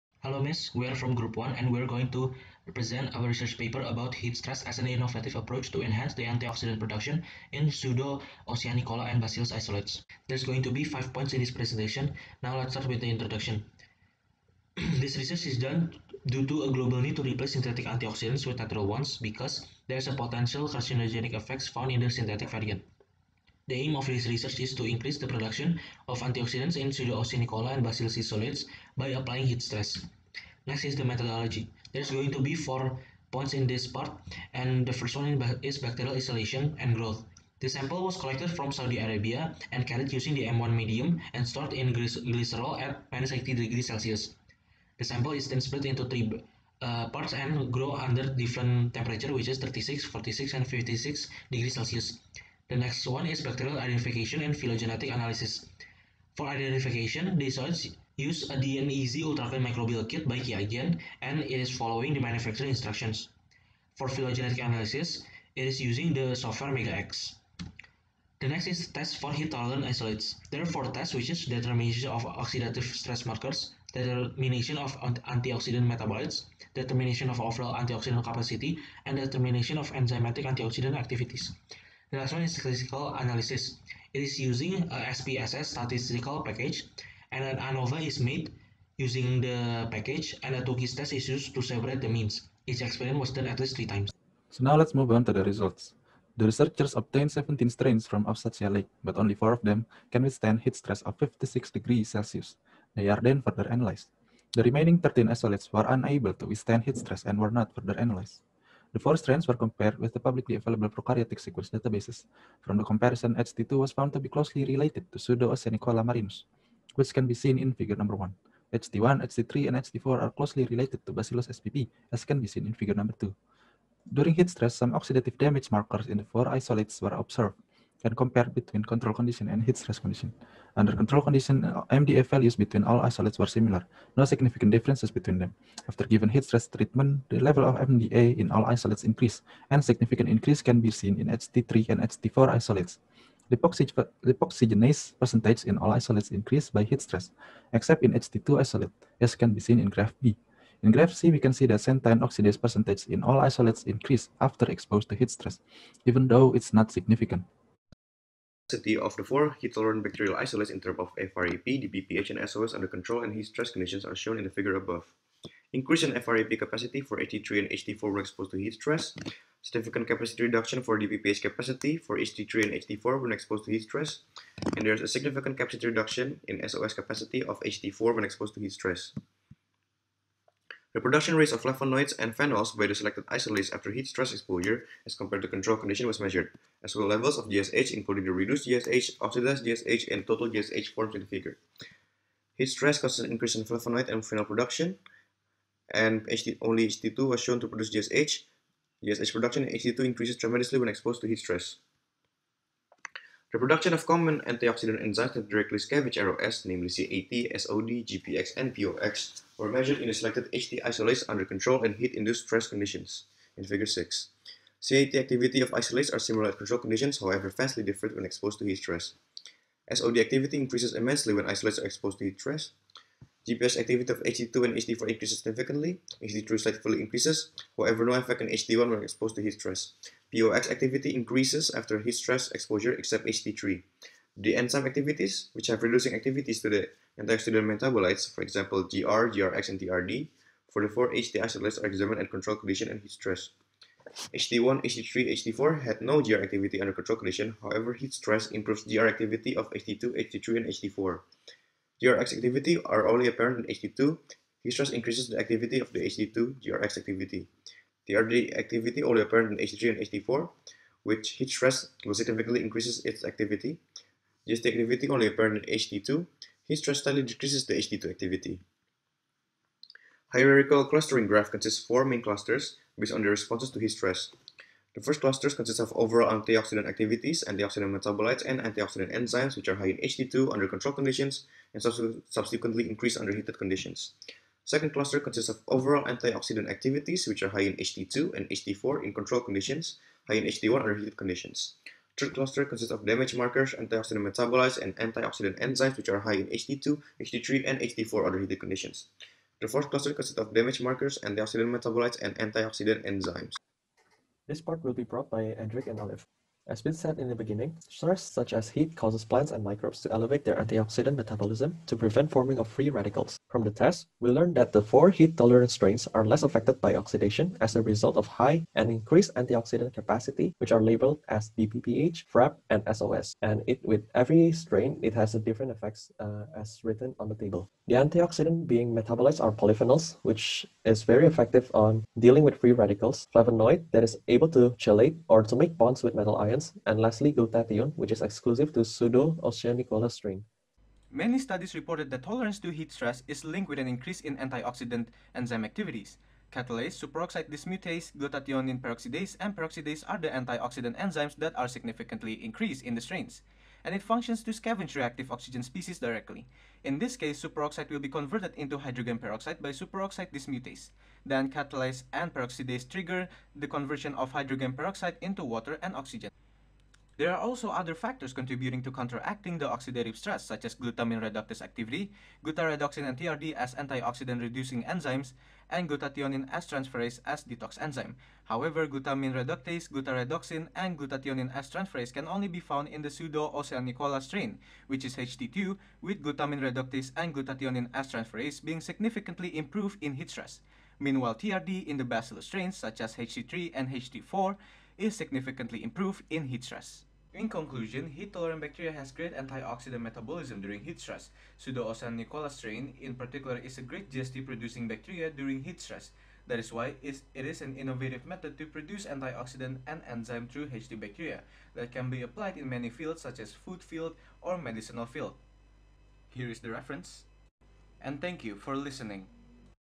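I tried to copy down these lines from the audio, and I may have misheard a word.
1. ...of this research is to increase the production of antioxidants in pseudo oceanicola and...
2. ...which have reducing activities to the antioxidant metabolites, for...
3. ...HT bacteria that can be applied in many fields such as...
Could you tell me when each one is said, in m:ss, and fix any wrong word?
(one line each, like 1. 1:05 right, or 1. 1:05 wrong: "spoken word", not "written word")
1. 0:23 right
2. 3:55 right
3. 6:50 right.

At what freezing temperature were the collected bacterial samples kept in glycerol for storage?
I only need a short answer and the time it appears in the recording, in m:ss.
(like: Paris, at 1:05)
-80 degrees Celsius, at 0:43.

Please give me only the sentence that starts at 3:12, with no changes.
Heat stress causes an increase in flavonoid and phenol production, and HD, only HT2 was shown to produce GSH.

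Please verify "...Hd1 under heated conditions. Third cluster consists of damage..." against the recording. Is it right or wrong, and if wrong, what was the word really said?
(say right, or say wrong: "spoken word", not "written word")
right.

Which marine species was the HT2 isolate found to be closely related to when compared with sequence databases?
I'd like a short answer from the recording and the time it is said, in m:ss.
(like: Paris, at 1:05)
Pseudo-Oceanicola marinus, at 1:55.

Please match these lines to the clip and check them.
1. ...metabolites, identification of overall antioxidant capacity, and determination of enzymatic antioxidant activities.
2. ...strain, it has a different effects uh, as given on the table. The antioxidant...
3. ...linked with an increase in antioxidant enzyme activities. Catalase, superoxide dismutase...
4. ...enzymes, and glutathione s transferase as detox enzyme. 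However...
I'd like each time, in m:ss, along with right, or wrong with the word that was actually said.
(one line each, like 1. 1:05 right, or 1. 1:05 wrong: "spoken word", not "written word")
1. 1:15 wrong: "determination", not "identification"
2. 5:24 wrong: "written", not "given"
3. 5:43 right
4. 6:14 right.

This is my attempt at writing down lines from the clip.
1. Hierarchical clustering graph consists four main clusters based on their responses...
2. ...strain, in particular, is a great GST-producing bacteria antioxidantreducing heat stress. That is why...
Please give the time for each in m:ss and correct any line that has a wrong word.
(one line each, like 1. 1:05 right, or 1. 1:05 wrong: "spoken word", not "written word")
1. 4:30 right
2. 6:42 wrong: "during", not "antioxidantreducing".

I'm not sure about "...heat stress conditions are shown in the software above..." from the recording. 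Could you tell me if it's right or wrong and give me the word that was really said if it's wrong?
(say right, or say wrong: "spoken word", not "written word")
wrong: "figure", not "software".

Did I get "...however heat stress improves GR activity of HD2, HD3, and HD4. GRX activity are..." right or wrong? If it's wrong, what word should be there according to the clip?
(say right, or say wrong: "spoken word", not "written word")
right.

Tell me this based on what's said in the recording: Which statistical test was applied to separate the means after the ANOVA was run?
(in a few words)
Tukey's test.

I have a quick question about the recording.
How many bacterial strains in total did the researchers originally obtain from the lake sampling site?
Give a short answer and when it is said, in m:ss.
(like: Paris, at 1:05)
17, at 1:37.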